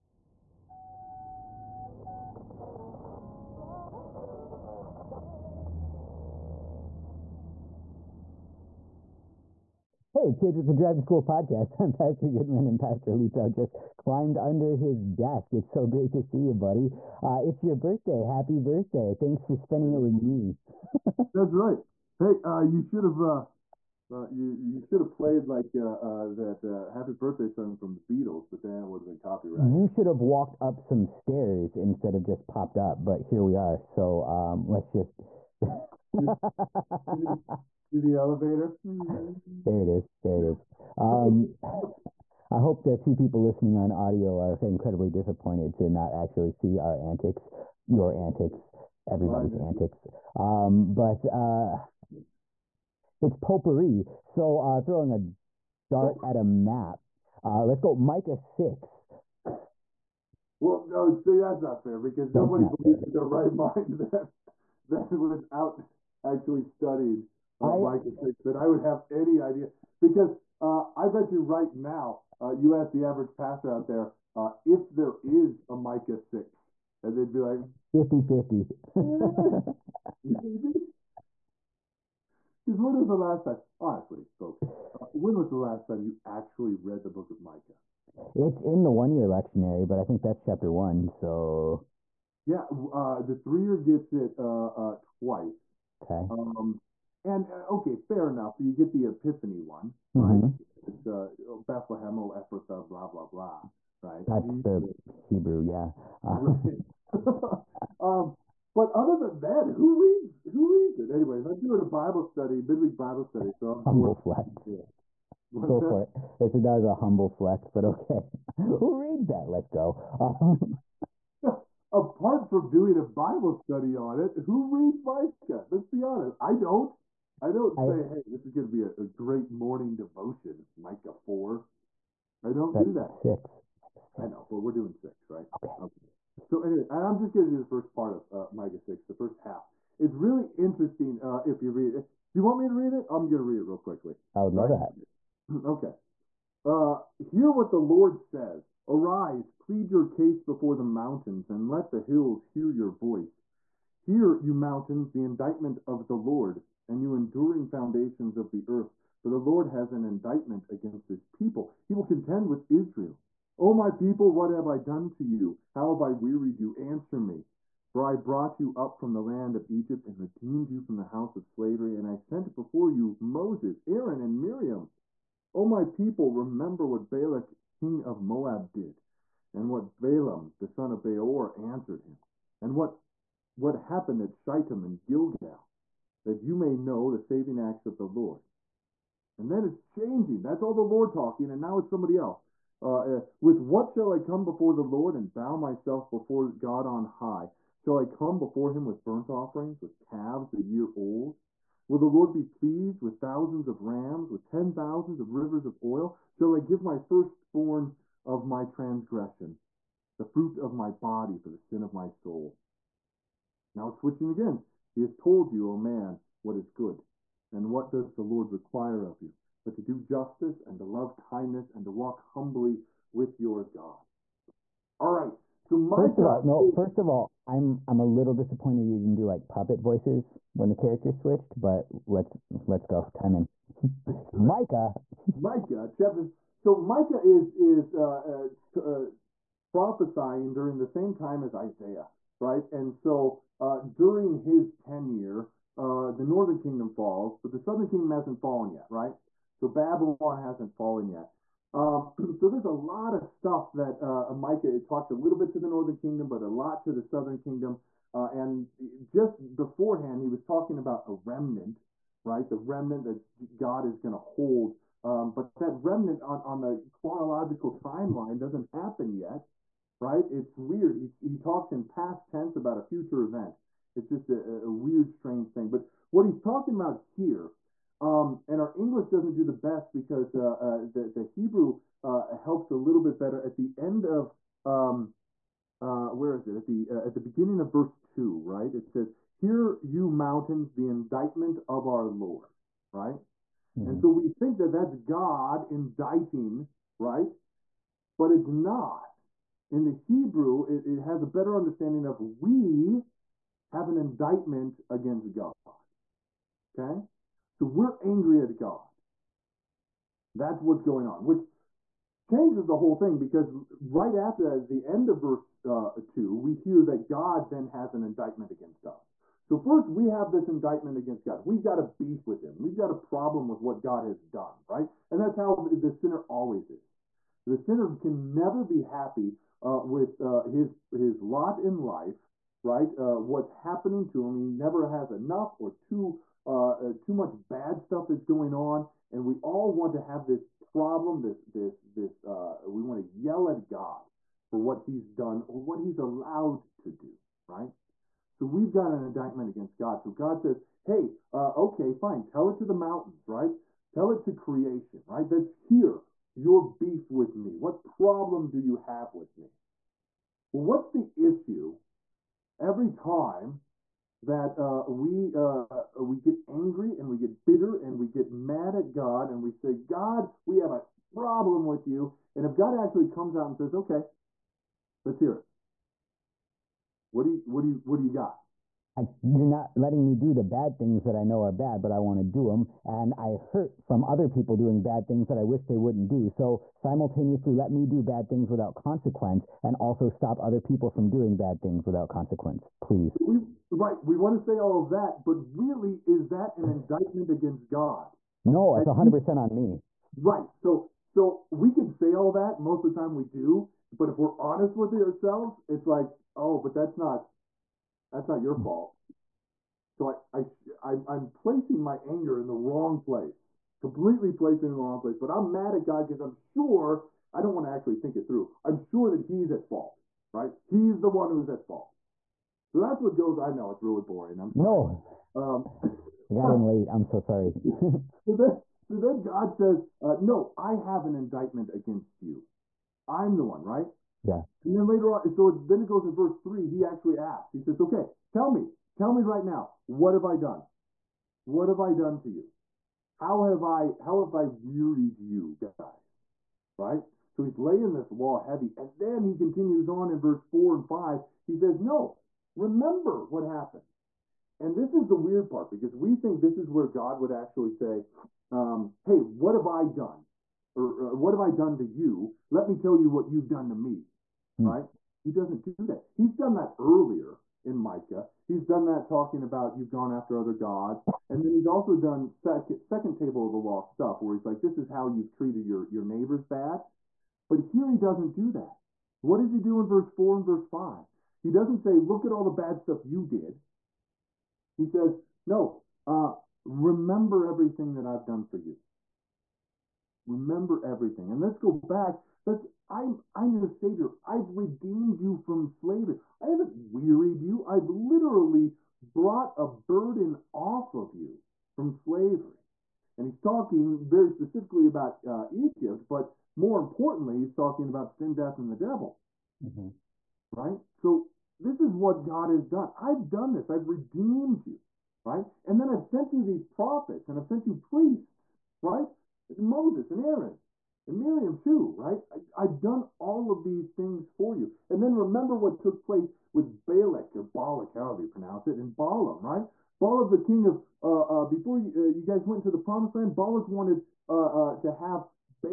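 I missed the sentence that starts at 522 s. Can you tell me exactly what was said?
I, have done all of these things for you.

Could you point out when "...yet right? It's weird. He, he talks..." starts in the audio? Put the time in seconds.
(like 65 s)
269 s.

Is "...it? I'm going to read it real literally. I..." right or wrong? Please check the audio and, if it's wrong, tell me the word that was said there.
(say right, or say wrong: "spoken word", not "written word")
wrong: "quickly", not "literally".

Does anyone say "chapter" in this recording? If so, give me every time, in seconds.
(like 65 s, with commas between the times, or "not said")
90 s, 235 s.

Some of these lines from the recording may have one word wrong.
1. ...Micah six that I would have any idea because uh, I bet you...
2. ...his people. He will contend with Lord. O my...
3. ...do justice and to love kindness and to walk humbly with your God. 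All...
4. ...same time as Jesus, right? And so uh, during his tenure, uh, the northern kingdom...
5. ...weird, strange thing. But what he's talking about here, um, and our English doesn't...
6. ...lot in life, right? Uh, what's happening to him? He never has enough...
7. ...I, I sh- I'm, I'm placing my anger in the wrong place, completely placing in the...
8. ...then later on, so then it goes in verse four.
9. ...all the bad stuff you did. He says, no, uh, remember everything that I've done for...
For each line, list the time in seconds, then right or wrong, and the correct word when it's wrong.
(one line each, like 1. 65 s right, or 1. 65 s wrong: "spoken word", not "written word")
1. 67 s right
2. 161 s wrong: "Israel", not "Lord"
3. 219 s right
4. 240 s wrong: "Isaiah", not "Jesus"
5. 274 s right
6. 331 s right
7. 410 s right
8. 434 s wrong: "three", not "four"
9. 482 s right.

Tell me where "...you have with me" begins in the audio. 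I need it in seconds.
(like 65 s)
358 s.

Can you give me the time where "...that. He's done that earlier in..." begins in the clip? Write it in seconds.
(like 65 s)
465 s.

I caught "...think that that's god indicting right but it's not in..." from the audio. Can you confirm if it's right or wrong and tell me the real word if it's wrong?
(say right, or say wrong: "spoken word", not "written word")
right.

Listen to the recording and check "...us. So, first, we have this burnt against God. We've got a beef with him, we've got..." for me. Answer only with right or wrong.
wrong.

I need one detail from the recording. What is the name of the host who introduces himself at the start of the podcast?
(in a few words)
Pastor Goodman.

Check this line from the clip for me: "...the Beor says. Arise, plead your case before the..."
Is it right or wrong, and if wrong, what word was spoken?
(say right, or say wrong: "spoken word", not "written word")
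wrong: "Lord", not "Beor".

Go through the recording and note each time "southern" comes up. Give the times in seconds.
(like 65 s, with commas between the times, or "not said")
247 s, 257 s.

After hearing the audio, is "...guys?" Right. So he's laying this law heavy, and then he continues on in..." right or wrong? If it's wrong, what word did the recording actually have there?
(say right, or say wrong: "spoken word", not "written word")
right.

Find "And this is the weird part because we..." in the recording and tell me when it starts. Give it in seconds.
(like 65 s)
454 s.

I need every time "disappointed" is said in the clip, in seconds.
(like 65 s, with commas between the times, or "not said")
45 s, 228 s.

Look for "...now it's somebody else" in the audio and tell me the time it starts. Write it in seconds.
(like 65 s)
191 s.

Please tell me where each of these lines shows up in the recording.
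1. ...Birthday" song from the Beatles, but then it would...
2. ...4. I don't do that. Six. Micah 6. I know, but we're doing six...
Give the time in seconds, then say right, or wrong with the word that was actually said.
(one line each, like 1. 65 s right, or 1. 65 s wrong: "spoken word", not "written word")
1. 27 s right
2. 131 s right.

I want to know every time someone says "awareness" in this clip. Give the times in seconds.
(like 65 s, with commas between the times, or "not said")
not said.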